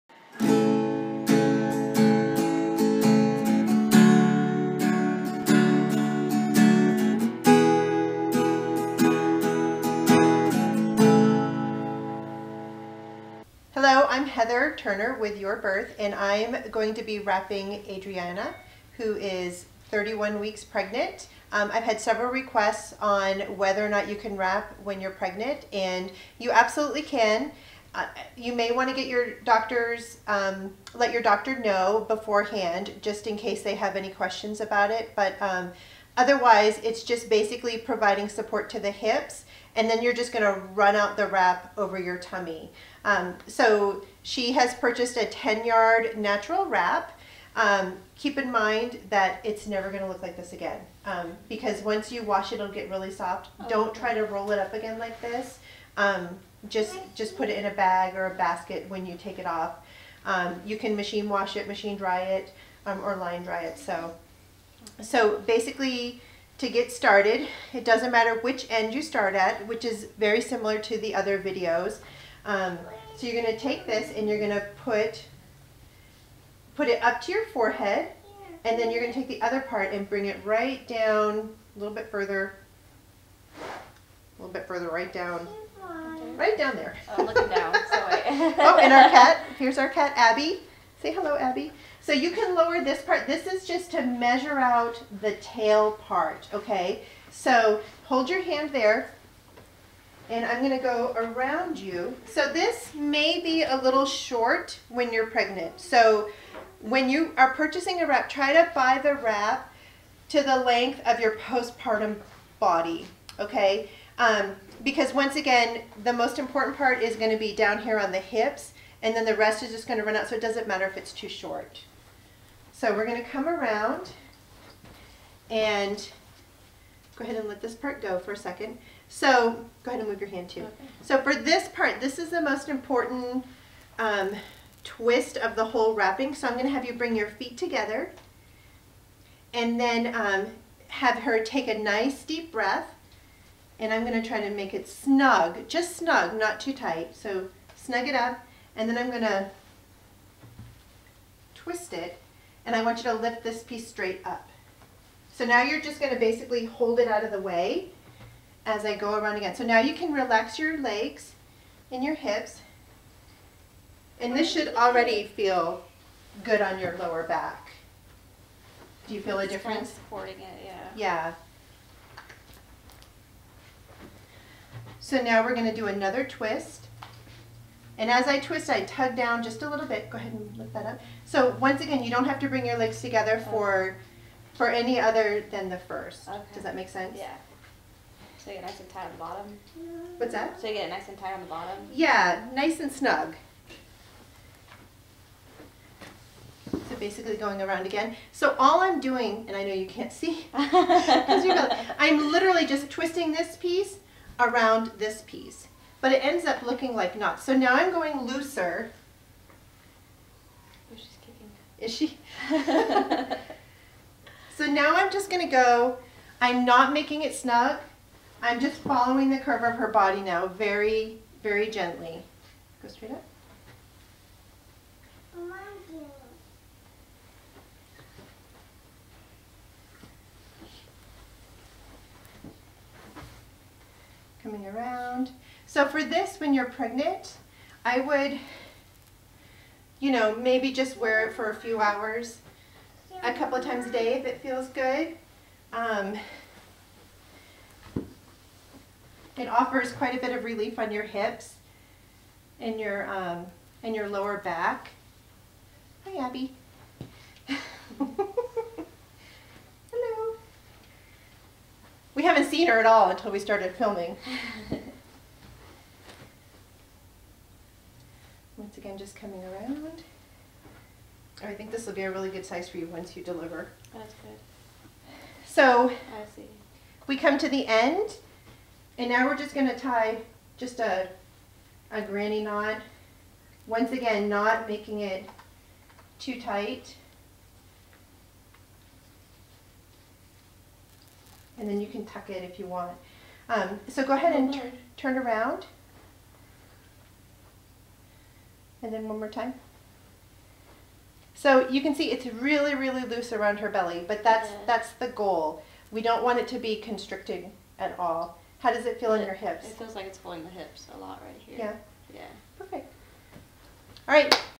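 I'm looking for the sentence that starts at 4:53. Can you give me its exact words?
Um, so go ahead and turn, turn around.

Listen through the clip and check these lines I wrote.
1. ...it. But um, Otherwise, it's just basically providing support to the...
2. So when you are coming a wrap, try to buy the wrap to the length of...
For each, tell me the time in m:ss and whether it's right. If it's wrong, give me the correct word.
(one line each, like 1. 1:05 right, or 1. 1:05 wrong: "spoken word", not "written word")
1. 0:34 right
2. 1:45 wrong: "purchasing", not "coming".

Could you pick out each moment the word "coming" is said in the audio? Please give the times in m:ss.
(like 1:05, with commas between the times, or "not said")
3:54, 4:29.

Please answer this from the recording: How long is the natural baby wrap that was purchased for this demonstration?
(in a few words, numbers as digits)
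10 yards.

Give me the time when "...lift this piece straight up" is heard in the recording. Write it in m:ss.
2:33.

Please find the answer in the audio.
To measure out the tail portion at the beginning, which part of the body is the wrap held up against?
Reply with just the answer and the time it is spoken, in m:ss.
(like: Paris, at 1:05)
Forehead, at 1:17.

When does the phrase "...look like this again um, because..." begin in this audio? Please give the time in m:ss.
0:50.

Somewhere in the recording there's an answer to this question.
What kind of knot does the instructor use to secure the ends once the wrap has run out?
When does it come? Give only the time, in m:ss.
4:42.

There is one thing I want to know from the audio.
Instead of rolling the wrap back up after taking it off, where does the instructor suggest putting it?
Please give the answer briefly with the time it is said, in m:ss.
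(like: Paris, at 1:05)
A bag or a basket, at 0:57.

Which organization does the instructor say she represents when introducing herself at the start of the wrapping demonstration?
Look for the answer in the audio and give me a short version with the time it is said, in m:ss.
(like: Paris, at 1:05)
Your Birth, at 0:15.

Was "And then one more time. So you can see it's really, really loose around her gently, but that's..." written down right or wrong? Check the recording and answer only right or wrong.
wrong.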